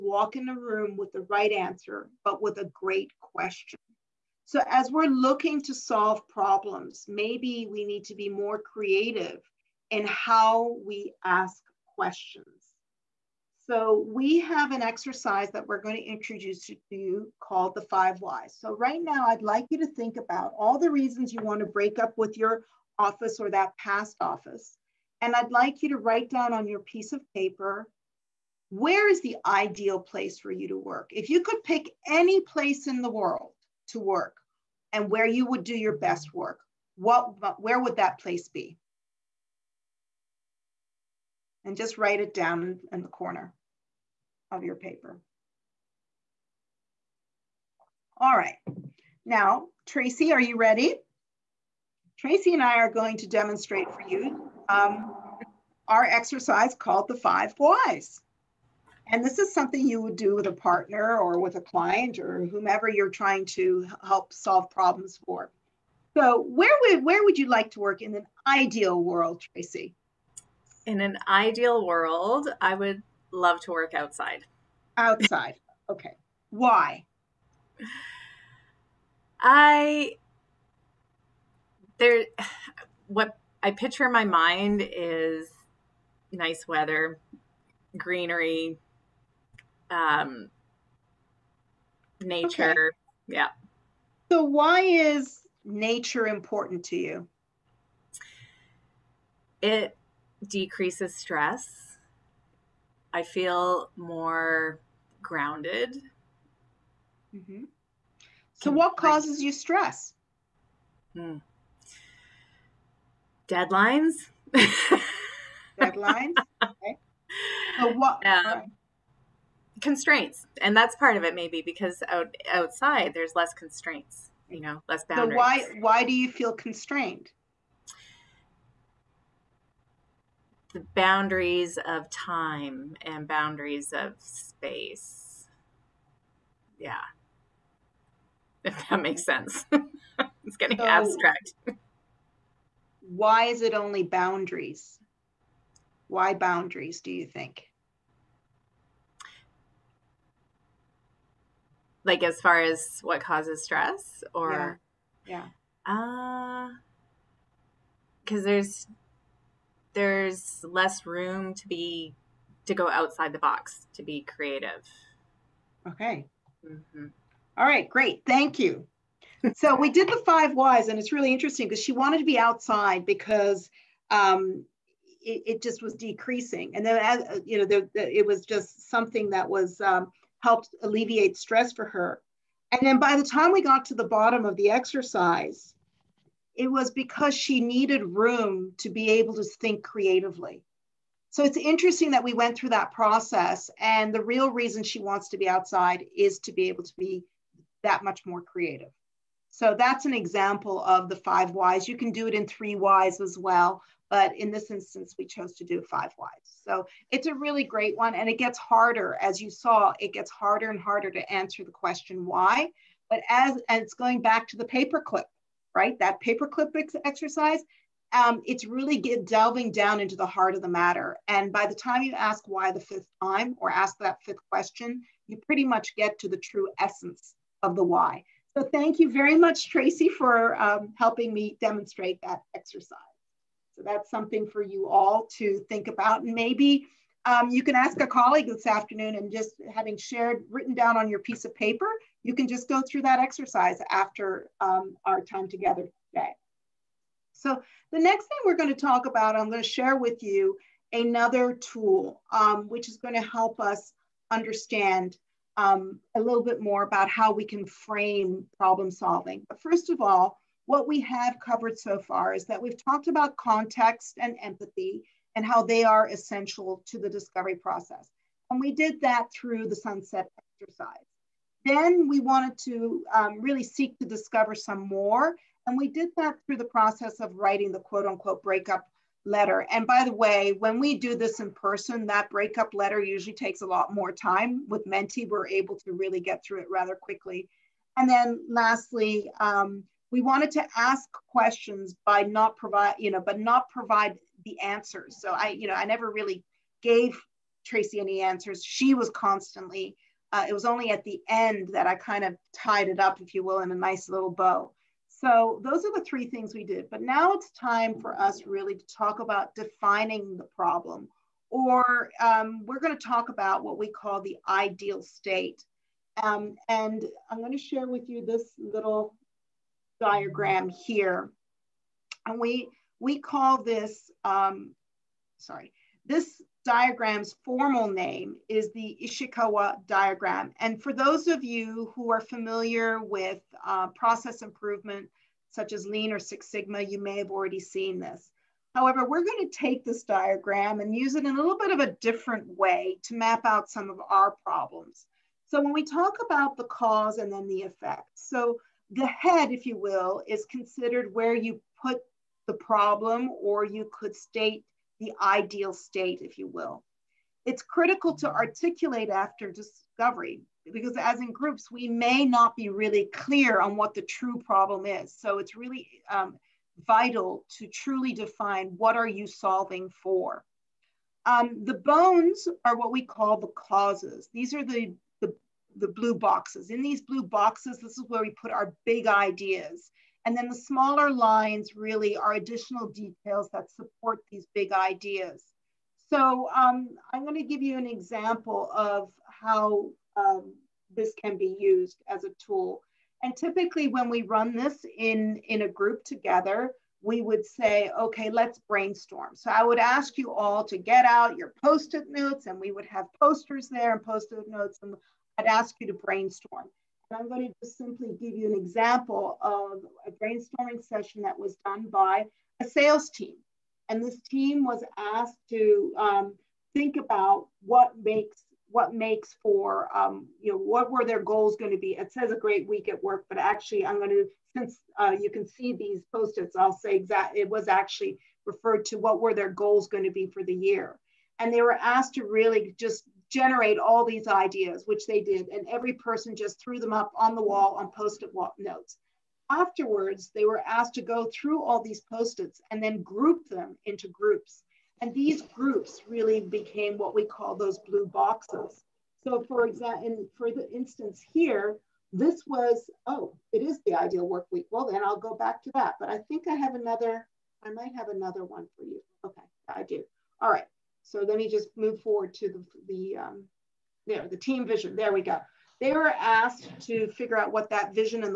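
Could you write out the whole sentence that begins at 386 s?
So um, I'm going to give you an example of how um, this can be used as a tool.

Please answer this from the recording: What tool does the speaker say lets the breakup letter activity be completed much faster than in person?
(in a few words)
Menti.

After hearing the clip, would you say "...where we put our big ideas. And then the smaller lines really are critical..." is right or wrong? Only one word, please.
wrong.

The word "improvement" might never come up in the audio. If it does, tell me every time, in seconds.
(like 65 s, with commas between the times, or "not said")
334 s.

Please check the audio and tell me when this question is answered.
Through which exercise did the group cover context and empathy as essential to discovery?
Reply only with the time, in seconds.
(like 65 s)
269 s.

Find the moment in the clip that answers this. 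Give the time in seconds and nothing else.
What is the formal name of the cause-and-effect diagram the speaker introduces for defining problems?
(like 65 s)
329 s.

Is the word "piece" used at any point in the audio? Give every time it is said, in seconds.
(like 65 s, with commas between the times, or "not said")
26 s, 241 s.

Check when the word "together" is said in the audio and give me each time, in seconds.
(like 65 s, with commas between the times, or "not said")
245 s, 396 s.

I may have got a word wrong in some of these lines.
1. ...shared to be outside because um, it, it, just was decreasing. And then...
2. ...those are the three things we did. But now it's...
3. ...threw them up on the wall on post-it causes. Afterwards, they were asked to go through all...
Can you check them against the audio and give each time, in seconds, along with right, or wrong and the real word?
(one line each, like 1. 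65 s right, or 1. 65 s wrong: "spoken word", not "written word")
1. 171 s wrong: "wanted", not "shared"
2. 305 s right
3. 436 s wrong: "notes", not "causes".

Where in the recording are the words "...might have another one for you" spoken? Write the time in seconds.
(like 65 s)
457 s.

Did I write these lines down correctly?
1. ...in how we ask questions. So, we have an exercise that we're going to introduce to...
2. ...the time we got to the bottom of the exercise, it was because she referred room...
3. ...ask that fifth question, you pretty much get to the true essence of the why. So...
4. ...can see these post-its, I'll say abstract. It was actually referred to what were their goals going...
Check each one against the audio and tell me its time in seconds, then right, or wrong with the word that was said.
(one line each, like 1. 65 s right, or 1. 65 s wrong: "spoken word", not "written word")
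1. 9 s right
2. 183 s wrong: "needed", not "referred"
3. 223 s right
4. 425 s wrong: "exact", not "abstract".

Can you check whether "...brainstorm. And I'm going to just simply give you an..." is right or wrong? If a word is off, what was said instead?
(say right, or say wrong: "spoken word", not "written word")
right.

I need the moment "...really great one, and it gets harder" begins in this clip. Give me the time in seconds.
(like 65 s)
207 s.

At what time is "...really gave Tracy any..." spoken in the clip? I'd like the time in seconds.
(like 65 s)
296 s.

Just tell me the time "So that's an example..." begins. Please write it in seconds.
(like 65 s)
199 s.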